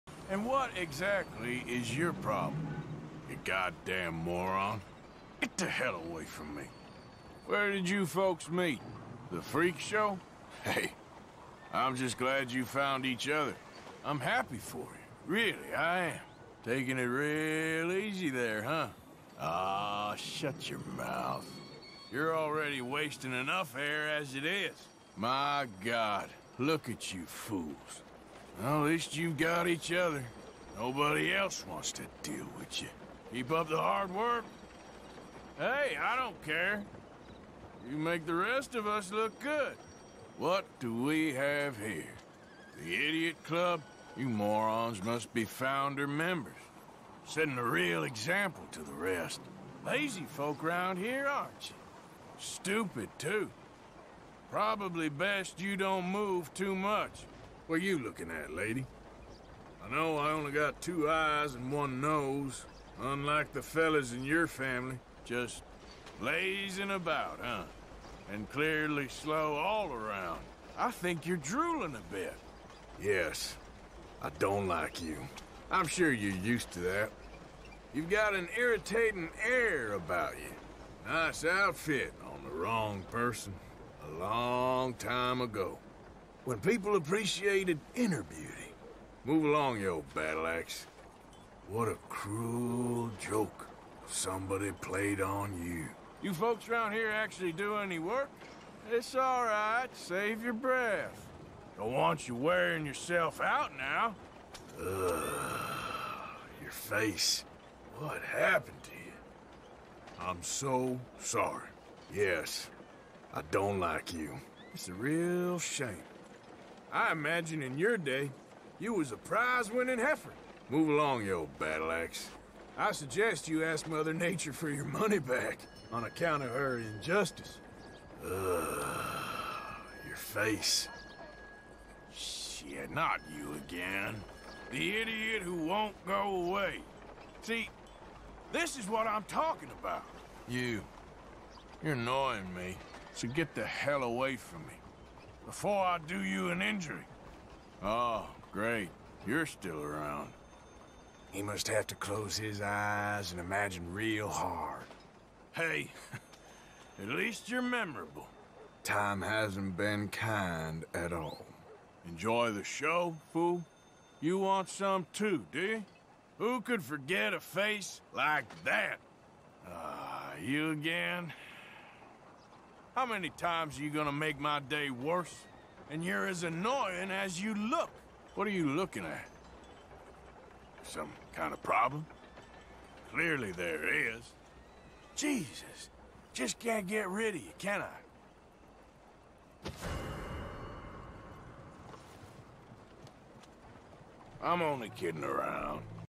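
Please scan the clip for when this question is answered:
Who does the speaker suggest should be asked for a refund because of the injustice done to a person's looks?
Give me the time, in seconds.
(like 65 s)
123 s.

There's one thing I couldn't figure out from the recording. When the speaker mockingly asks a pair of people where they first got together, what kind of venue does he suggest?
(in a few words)
The freak show.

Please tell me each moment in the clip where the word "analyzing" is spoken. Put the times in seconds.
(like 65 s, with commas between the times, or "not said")
not said.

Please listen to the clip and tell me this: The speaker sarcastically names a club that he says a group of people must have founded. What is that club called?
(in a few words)
The Idiot Club.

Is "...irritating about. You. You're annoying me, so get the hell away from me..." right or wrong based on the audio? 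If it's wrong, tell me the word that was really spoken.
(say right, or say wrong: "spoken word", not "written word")
wrong: "talking", not "irritating".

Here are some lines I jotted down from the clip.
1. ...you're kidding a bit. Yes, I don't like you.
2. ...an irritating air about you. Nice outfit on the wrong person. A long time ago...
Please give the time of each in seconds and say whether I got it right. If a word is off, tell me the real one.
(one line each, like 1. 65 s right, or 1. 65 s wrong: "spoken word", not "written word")
1. 71 s wrong: "drooling", not "kidding"
2. 78 s right.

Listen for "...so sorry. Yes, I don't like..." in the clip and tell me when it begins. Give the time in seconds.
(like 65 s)
110 s.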